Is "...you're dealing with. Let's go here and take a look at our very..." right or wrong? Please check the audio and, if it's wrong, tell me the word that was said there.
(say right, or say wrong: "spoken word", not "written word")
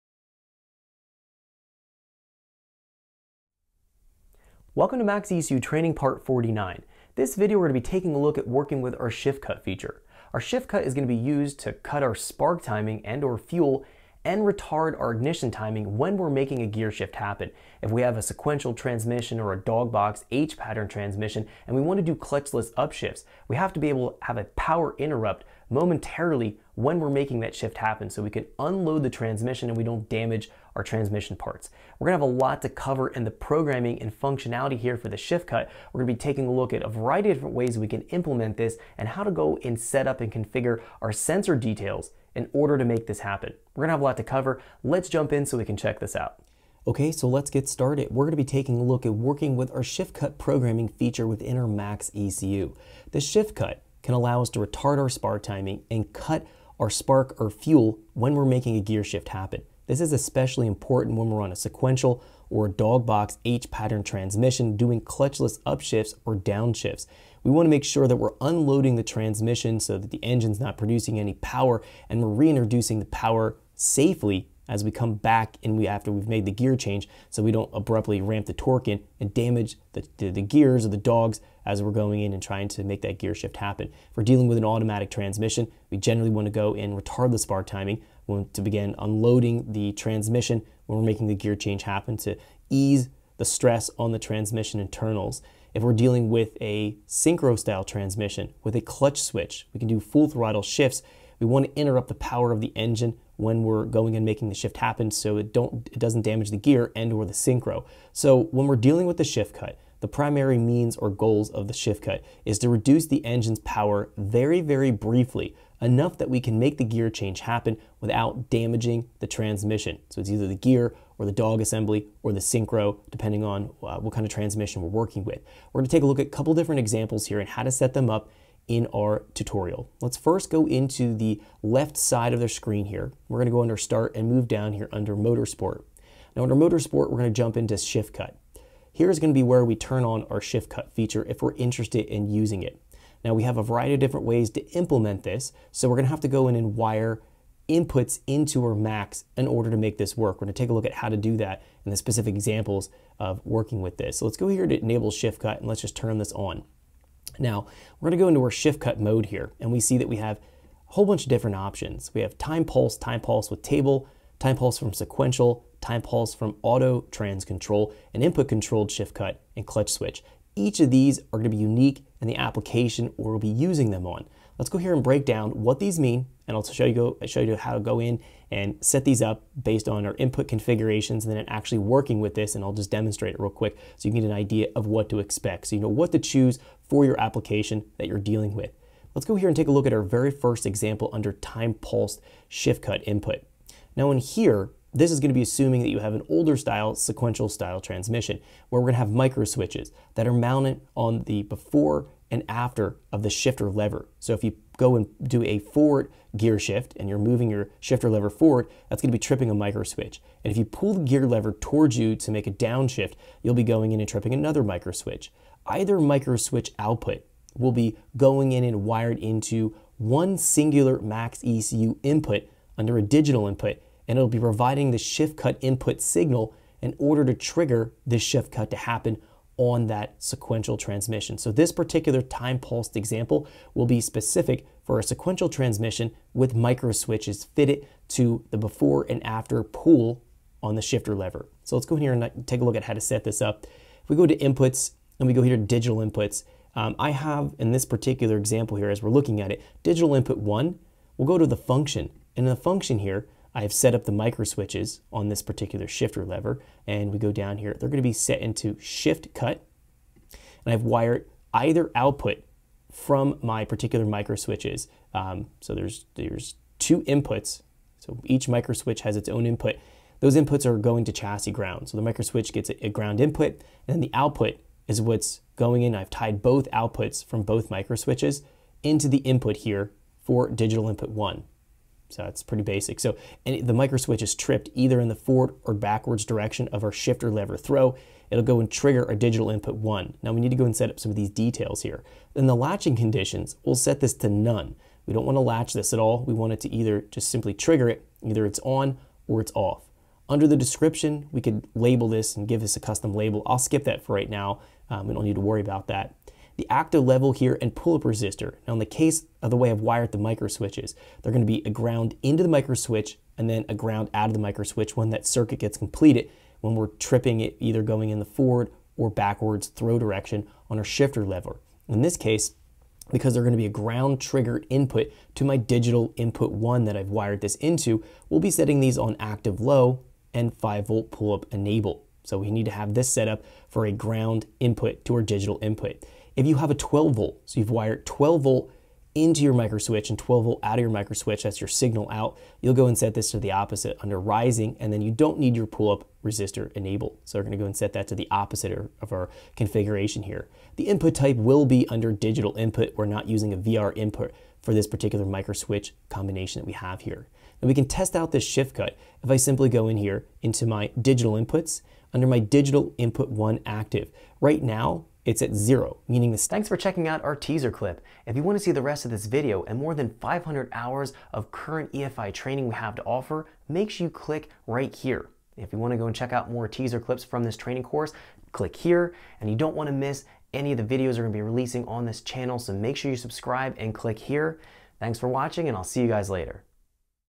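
right.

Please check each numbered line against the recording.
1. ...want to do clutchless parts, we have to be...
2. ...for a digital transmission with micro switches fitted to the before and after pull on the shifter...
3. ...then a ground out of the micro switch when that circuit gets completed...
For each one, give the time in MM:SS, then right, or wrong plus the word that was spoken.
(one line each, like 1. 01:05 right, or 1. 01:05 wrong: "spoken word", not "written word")
1. 00:21 wrong: "upshifts", not "parts"
2. 03:54 wrong: "sequential", not "digital"
3. 05:13 right.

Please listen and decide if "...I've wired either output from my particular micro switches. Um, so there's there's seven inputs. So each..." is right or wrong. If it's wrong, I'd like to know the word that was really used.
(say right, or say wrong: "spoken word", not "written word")
wrong: "two", not "seven".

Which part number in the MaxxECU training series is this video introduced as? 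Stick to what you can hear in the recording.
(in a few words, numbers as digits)
49.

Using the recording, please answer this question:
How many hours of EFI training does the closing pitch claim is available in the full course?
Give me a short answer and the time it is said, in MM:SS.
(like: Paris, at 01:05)
500, at 06:10.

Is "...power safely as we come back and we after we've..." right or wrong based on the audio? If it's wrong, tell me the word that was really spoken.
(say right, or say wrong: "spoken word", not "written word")
right.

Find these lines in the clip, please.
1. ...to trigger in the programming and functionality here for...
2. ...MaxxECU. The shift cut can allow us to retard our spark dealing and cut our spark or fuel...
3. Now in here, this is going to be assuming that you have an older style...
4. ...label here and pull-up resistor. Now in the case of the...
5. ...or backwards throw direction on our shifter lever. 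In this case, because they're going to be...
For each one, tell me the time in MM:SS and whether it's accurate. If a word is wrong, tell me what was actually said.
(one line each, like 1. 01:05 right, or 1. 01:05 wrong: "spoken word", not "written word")
1. 00:32 wrong: "cover", not "trigger"
2. 00:51 wrong: "timing", not "dealing"
3. 03:13 right
4. 05:07 wrong: "level", not "label"
5. 05:18 right.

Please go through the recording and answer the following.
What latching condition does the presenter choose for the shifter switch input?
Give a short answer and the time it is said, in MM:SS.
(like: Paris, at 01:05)
none, at 04:54.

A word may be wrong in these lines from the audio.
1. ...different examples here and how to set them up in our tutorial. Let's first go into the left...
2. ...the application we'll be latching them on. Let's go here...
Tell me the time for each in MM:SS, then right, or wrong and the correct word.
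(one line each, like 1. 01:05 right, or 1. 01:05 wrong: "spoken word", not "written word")
1. 02:06 right
2. 02:52 wrong: "using", not "latching".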